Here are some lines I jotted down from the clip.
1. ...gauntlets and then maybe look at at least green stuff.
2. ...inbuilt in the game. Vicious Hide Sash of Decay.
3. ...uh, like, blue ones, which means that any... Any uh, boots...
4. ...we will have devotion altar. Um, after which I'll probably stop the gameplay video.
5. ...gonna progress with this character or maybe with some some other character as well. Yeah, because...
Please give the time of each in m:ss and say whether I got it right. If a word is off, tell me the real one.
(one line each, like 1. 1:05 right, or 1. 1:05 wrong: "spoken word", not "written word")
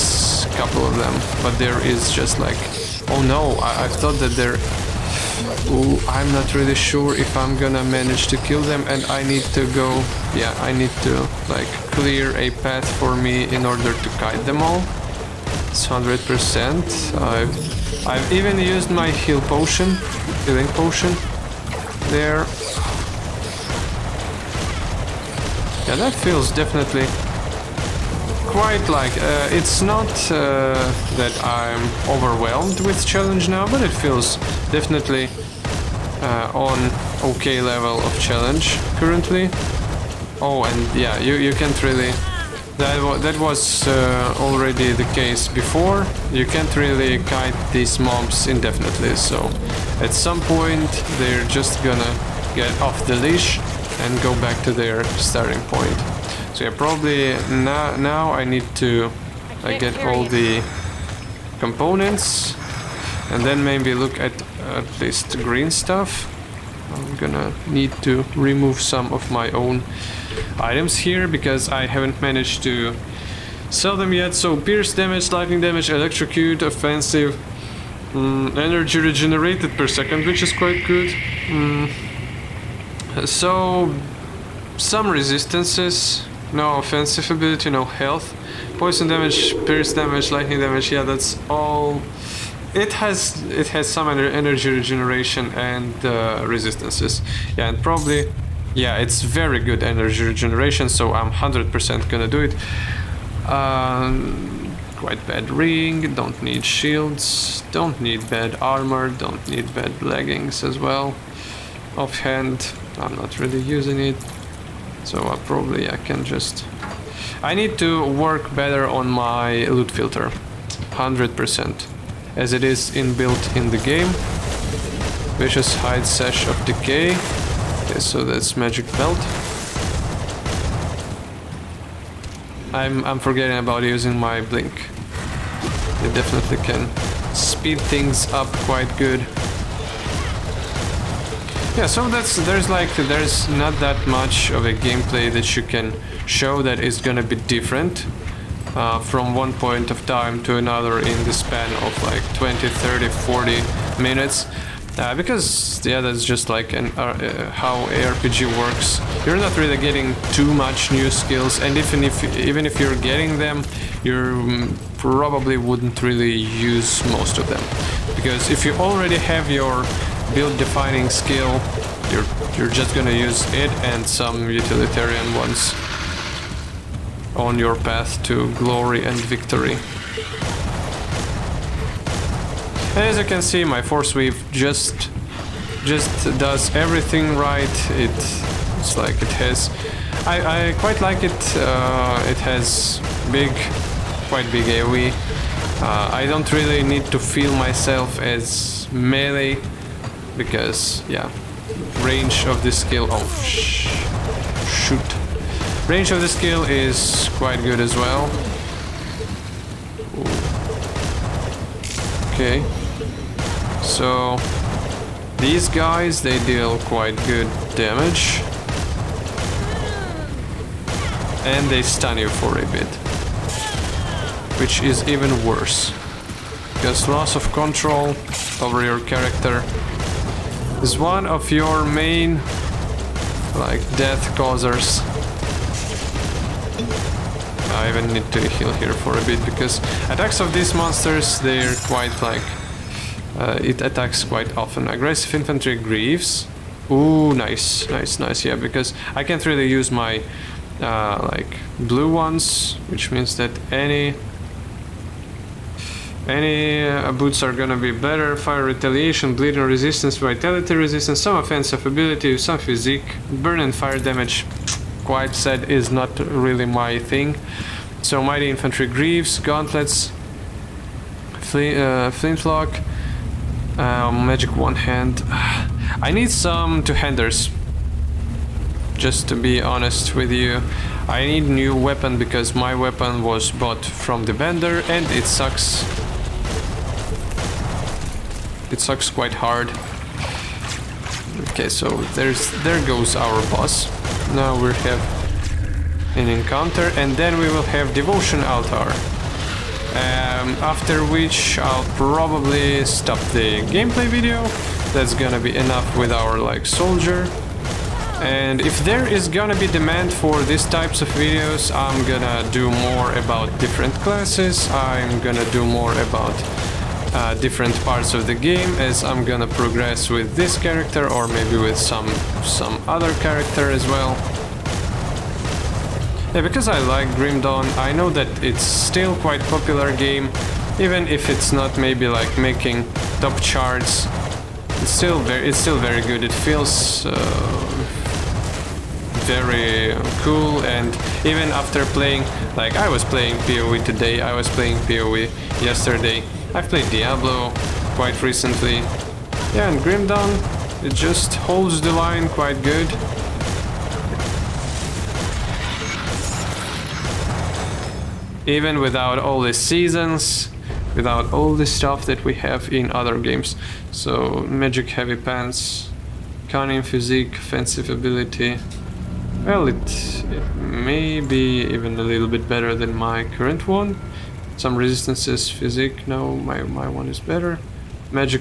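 1. 1:01 wrong: "components", not "gauntlets"
2. 2:02 right
3. 4:10 right
4. 4:57 right
5. 5:19 right.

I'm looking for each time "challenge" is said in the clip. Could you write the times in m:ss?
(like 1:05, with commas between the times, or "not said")
0:33, 0:38.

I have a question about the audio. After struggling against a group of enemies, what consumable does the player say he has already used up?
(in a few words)
healing potion.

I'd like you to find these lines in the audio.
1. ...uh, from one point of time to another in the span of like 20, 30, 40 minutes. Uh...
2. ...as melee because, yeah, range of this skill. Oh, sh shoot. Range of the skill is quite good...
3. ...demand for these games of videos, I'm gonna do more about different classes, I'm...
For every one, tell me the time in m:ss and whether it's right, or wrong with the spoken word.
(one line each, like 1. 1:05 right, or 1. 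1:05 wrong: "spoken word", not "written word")
1. 2:28 right
2. 3:18 right
3. 5:09 wrong: "types", not "games".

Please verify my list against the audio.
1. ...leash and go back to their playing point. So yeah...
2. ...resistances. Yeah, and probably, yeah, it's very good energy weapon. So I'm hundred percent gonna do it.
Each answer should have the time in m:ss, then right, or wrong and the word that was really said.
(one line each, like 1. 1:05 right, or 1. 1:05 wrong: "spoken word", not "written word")
1. 0:53 wrong: "starting", not "playing"
2. 1:36 wrong: "regeneration", not "weapon".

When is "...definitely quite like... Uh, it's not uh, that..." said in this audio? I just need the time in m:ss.
0:26.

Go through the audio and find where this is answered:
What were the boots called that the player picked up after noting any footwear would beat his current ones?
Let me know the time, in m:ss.
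4:04.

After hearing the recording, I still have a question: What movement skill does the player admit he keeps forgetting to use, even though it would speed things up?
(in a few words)
blink.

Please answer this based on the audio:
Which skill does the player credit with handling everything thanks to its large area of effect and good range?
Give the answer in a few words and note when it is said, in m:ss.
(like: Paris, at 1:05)
forcewave, at 3:03.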